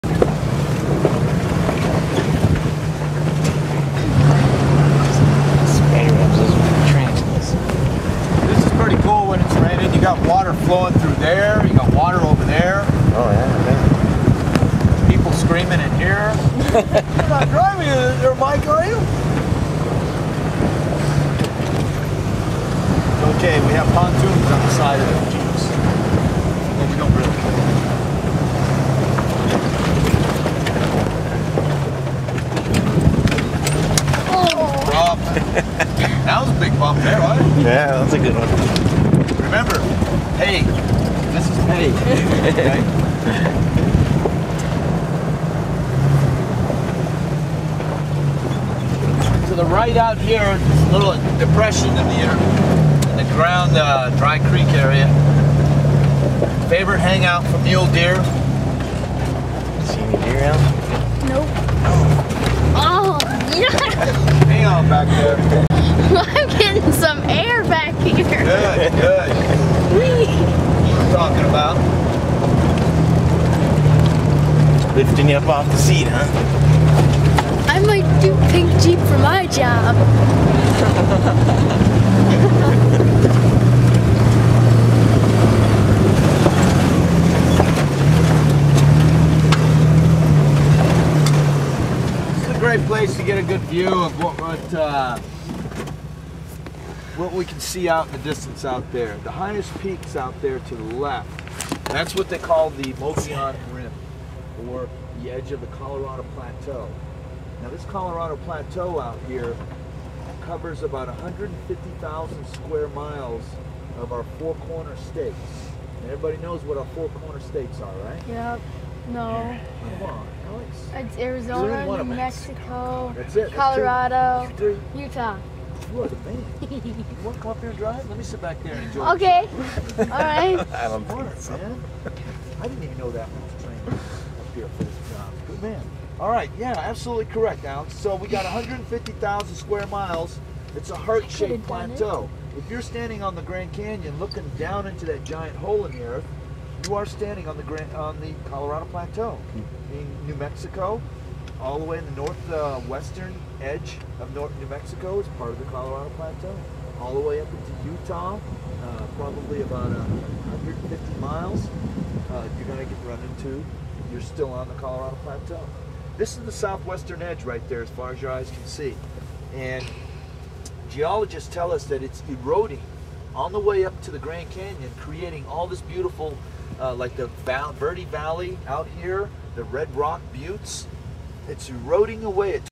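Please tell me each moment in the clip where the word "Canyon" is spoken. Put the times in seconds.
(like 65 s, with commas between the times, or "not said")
143 s, 174 s.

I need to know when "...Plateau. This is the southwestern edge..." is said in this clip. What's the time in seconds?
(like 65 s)
165 s.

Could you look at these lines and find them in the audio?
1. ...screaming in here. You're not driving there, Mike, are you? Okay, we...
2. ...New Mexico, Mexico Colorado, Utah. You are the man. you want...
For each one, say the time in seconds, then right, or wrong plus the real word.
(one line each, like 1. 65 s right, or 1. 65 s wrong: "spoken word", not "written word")
1. 15 s right
2. 121 s right.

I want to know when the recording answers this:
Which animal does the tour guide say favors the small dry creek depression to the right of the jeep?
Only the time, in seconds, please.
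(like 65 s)
57 s.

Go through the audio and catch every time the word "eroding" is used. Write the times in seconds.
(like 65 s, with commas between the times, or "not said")
172 s, 181 s.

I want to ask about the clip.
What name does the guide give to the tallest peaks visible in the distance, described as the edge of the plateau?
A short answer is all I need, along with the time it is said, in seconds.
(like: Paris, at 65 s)
Mogollon Rim, at 102 s.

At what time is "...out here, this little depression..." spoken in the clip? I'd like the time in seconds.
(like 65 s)
49 s.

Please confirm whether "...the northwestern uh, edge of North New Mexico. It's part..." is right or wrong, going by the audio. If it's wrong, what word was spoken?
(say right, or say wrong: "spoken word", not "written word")
right.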